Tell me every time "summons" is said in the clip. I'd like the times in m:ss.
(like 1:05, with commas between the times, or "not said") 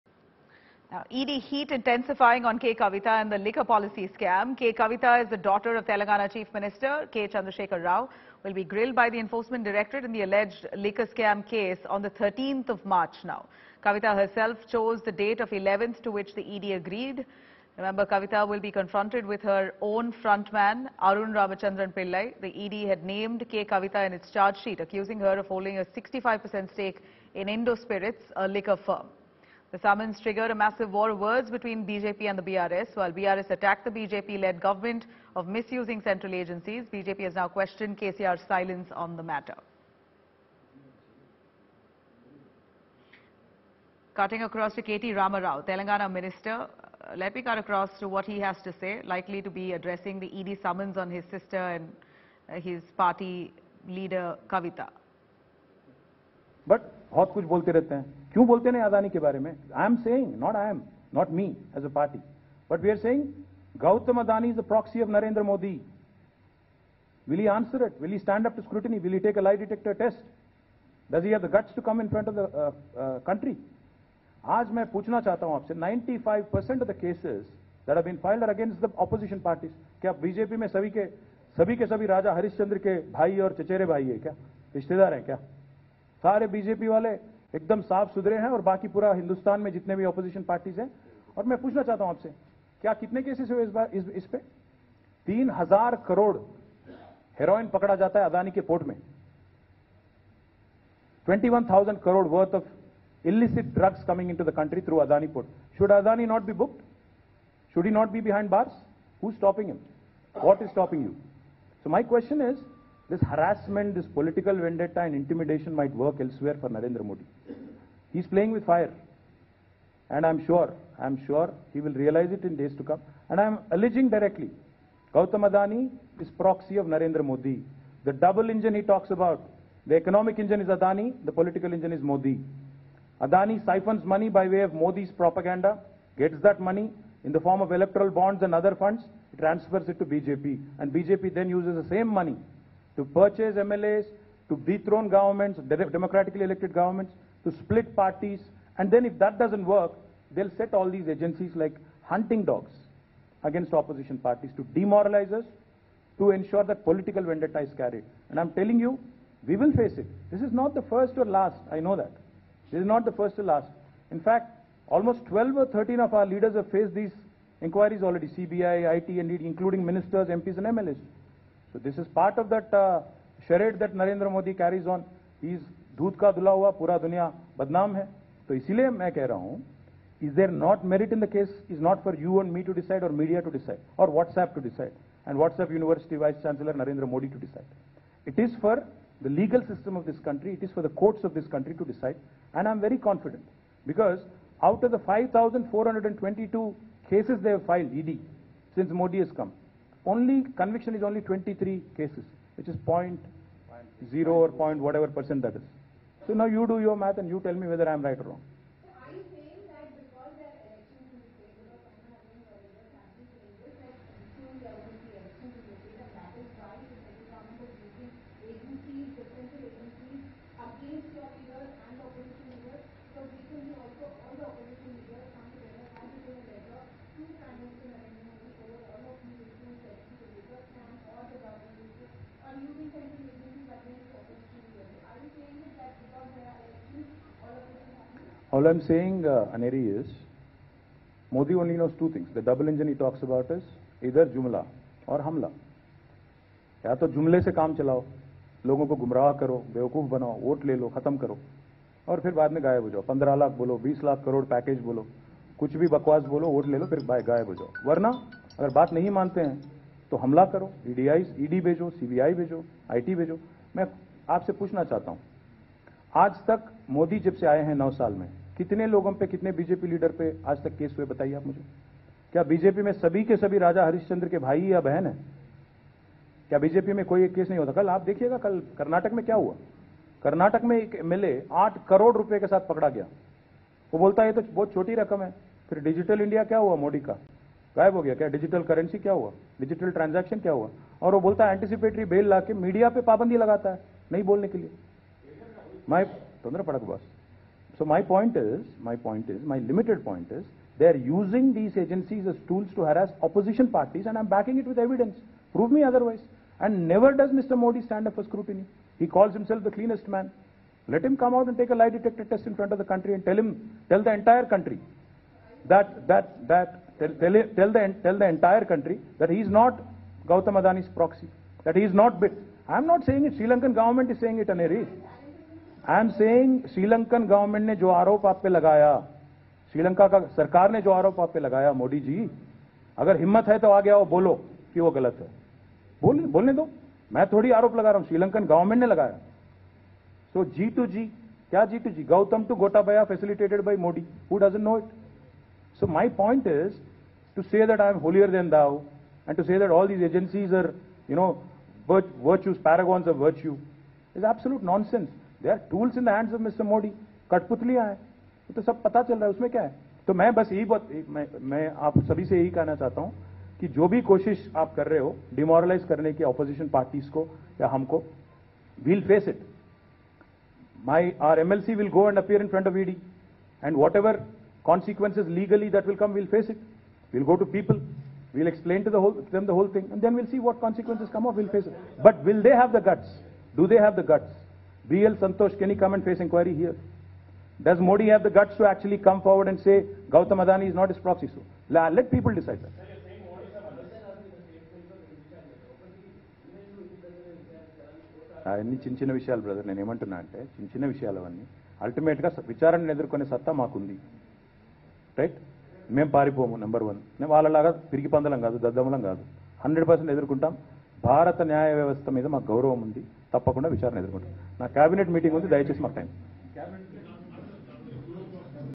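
0:29, 0:50.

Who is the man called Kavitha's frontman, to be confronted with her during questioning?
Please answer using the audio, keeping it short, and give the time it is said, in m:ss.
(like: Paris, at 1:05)
Arun Ramachandran Pillai, at 0:21.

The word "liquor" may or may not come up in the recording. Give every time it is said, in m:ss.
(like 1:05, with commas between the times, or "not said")
0:03, 0:10, 0:28.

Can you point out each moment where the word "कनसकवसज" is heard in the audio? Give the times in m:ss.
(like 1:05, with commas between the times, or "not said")
6:14, 6:20.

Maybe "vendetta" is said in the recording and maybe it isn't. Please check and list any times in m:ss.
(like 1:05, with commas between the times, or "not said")
1:54, 2:37.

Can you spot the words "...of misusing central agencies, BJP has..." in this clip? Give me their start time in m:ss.
0:35.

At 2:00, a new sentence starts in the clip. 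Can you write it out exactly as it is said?
And I'm sure, I'm sure he will realize it in days to come.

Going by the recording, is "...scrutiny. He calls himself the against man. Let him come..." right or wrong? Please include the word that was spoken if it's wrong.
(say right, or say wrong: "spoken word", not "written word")
wrong: "cleanest", not "against".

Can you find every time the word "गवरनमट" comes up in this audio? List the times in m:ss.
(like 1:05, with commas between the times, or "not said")
5:27, 5:38.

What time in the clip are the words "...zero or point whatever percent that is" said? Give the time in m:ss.
3:24.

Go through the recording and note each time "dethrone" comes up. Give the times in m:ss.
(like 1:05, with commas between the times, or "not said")
2:24.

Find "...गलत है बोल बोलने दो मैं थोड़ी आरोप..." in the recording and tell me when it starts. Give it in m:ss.
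5:34.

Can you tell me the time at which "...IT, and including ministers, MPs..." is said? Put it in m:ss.
2:48.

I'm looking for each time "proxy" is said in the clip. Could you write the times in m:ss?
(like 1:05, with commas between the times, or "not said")
2:06, 5:20, 6:30.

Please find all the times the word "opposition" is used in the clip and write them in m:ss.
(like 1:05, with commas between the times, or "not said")
2:33, 5:03.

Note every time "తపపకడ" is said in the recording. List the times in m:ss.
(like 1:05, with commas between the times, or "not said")
6:53.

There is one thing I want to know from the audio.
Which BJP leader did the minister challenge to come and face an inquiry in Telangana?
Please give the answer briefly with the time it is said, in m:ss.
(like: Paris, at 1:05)
BL Santosh, at 6:24.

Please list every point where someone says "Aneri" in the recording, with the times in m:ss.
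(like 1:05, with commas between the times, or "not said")
3:59, 5:24.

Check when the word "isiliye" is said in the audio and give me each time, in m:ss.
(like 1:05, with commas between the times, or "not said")
2:58.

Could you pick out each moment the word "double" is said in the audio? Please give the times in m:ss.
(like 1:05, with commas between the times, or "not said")
2:08, 4:02.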